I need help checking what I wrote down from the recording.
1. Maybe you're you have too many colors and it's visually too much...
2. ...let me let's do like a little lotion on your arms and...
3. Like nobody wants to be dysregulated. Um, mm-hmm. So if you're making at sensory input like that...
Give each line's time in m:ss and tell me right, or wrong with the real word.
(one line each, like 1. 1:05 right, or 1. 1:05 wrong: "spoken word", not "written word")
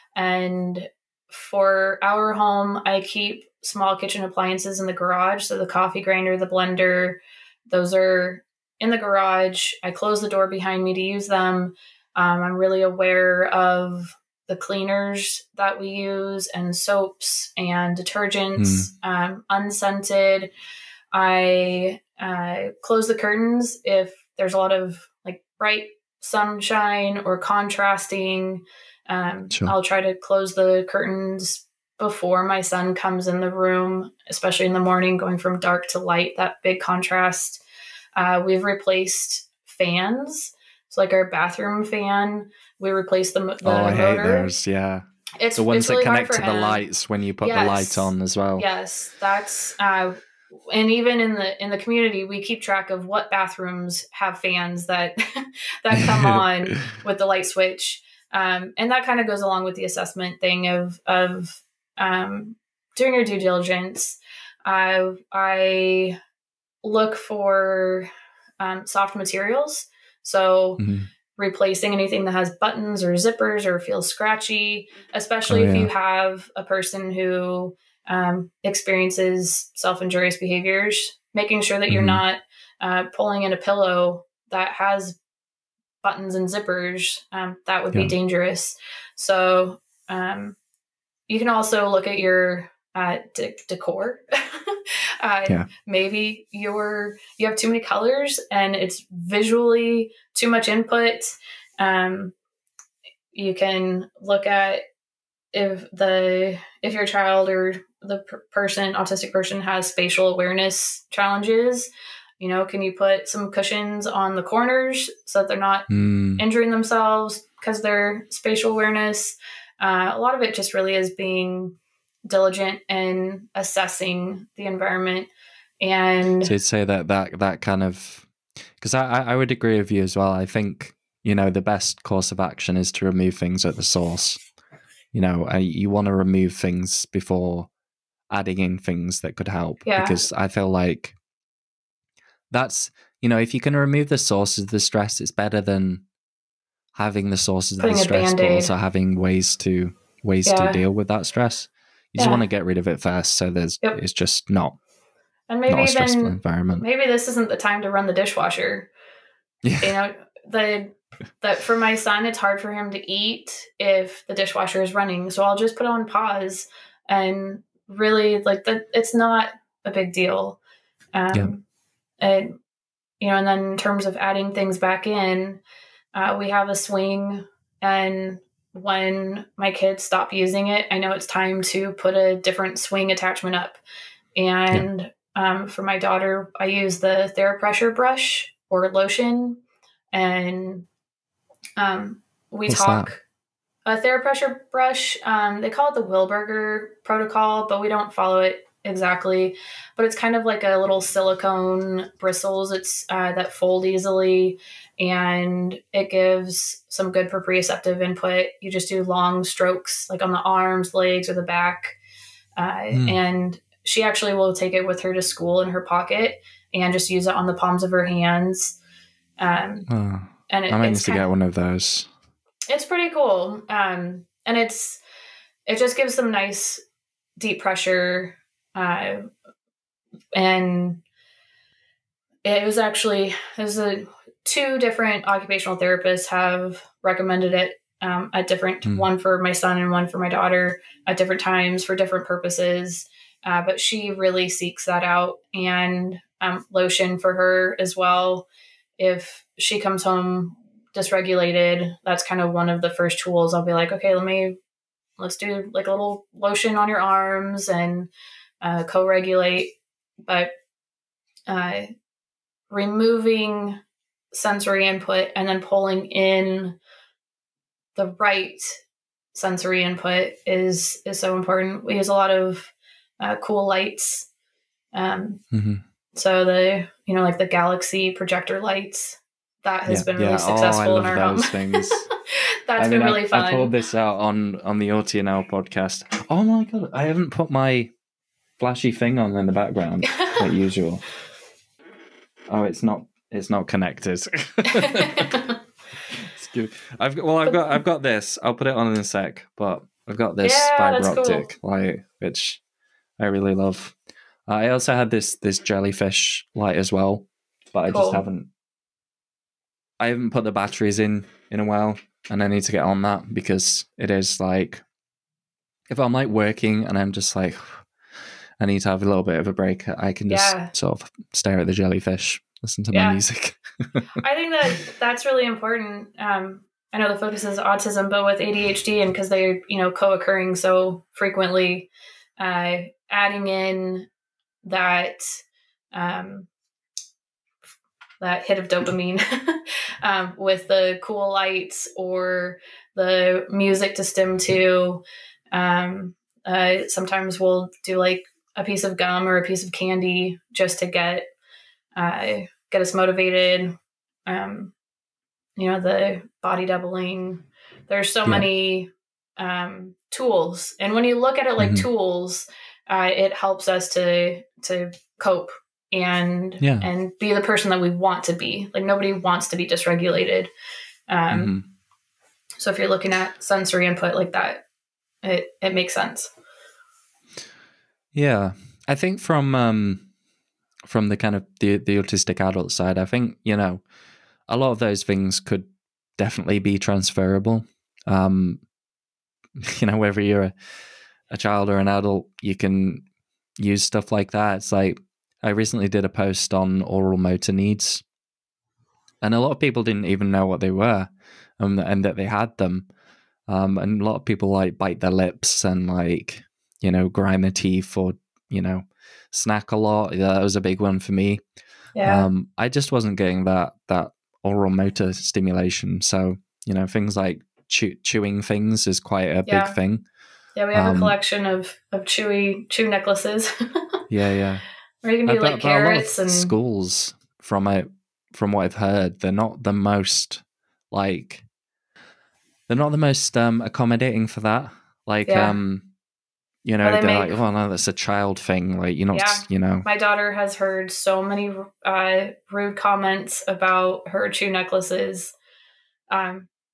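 1. 1:35 right
2. 4:14 right
3. 6:08 wrong: "looking", not "making".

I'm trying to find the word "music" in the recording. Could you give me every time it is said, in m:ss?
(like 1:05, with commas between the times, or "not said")
5:23, 5:43.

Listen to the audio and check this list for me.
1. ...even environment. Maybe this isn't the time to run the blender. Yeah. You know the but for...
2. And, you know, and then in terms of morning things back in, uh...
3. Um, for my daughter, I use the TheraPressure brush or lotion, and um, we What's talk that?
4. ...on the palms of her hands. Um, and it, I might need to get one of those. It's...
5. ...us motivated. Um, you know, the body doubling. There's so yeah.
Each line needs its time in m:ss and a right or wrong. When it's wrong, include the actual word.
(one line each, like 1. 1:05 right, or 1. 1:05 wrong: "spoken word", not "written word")
1. 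2:36 wrong: "dishwasher", not "blender"
2. 2:52 wrong: "adding", not "morning"
3. 3:05 right
4. 3:37 right
5. 5:52 right.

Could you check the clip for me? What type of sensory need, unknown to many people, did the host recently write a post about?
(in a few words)
oral motor needs.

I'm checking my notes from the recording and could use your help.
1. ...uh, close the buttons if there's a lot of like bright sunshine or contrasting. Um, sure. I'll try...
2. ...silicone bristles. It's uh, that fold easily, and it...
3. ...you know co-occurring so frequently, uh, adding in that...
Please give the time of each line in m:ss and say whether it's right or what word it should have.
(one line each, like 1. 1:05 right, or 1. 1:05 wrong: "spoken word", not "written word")
1. 0:22 wrong: "curtains", not "buttons"
2. 3:21 right
3. 5:29 right.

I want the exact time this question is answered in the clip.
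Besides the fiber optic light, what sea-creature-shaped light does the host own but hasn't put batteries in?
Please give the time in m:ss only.
5:05.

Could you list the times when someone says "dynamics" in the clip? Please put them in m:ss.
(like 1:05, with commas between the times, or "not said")
not said.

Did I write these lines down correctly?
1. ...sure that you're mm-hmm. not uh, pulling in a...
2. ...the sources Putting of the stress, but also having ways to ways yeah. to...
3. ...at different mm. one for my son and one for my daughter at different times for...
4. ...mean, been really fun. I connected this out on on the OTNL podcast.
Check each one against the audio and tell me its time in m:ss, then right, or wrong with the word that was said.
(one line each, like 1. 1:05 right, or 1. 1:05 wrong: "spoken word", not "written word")
1. 1:21 right
2. 2:27 right
3. 3:58 right
4. 4:42 wrong: "pulled", not "connected".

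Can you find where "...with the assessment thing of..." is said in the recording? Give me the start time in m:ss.
0:59.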